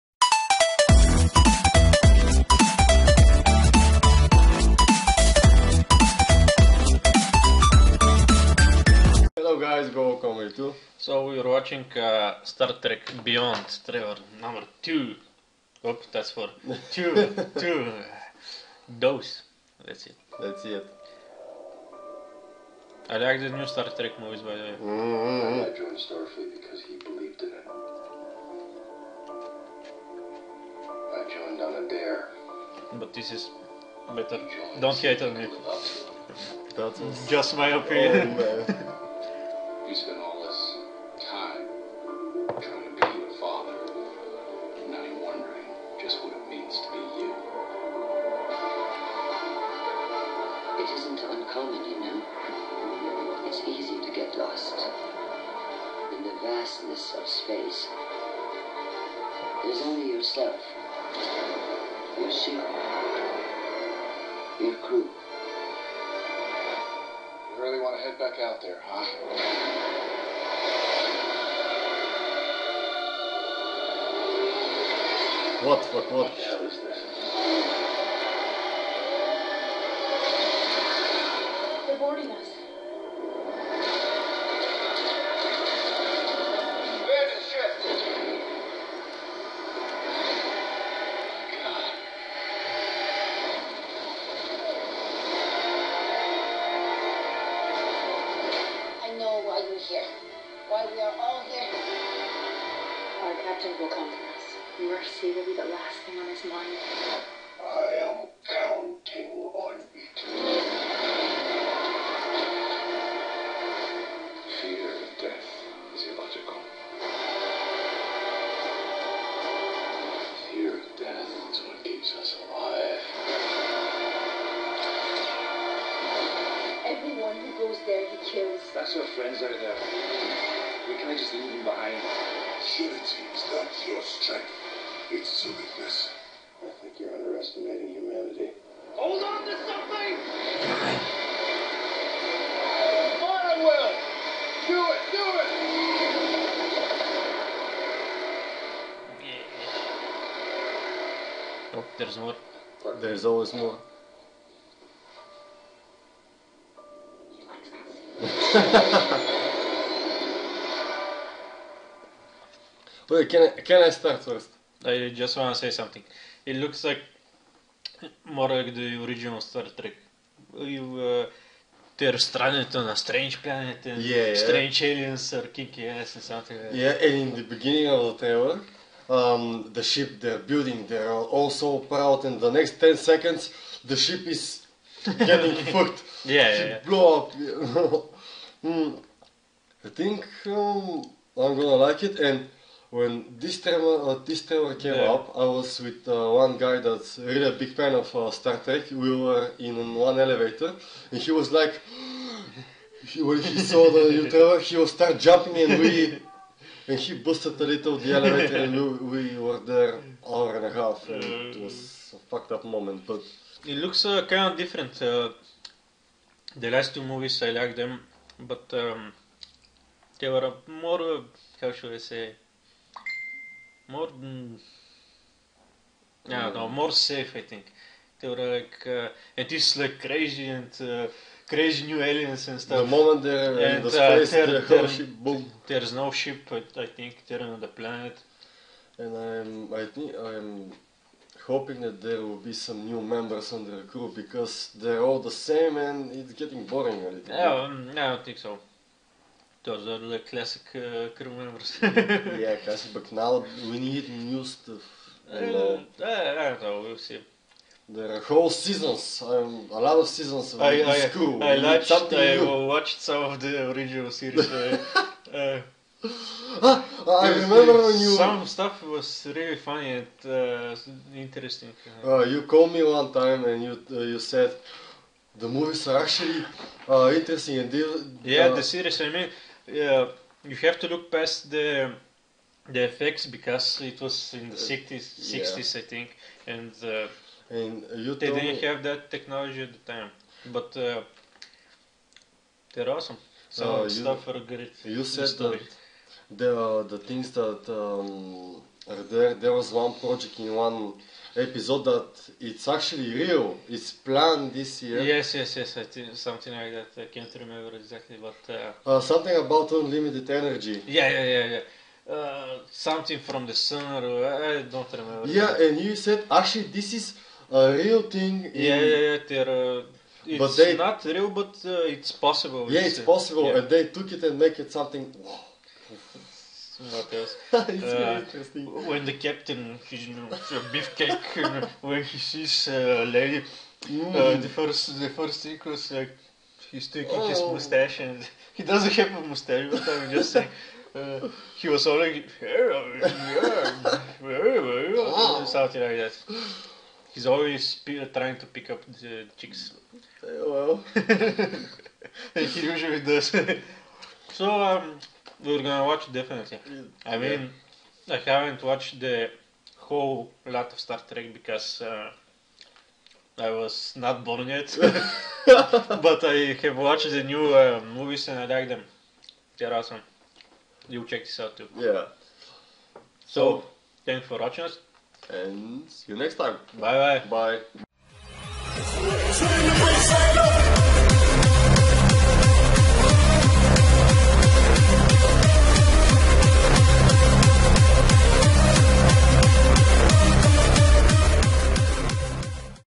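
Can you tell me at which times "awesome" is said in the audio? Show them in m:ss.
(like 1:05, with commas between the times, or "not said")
4:52, 6:09.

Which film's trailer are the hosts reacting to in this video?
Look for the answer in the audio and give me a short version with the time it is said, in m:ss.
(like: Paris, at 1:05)
Star Trek Beyond, at 0:12.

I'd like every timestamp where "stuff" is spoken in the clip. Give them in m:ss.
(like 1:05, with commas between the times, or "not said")
3:52, 4:14, 4:28, 4:53.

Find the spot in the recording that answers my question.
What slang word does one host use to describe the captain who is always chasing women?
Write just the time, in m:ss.
5:30.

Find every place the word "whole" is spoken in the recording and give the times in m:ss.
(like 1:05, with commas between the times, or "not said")
4:18, 5:59.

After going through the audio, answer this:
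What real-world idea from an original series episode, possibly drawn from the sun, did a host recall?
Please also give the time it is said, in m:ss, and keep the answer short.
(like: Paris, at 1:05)
unlimited energy, at 5:09.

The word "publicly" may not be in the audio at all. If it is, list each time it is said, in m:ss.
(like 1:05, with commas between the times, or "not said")
not said.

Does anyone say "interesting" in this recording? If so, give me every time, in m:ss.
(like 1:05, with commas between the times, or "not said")
4:31, 4:37, 5:28.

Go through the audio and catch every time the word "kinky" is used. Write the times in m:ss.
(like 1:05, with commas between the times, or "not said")
2:55.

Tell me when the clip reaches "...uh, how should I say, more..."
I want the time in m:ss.
3:41.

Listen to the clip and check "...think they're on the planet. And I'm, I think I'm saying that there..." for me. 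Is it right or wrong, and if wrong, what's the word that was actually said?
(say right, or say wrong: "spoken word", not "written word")
wrong: "hoping", not "saying".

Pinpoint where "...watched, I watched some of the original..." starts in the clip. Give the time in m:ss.
4:21.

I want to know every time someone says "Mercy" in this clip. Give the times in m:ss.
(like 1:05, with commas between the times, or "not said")
1:44.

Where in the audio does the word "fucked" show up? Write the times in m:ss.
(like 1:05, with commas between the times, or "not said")
3:05, 3:32.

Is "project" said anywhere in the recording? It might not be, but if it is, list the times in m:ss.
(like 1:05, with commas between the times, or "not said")
4:59.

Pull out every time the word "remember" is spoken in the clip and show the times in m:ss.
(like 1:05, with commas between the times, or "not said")
4:27, 5:07, 5:14.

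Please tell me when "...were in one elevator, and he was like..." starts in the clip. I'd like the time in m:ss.
3:19.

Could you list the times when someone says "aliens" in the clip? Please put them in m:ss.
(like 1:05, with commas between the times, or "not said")
2:54, 3:52.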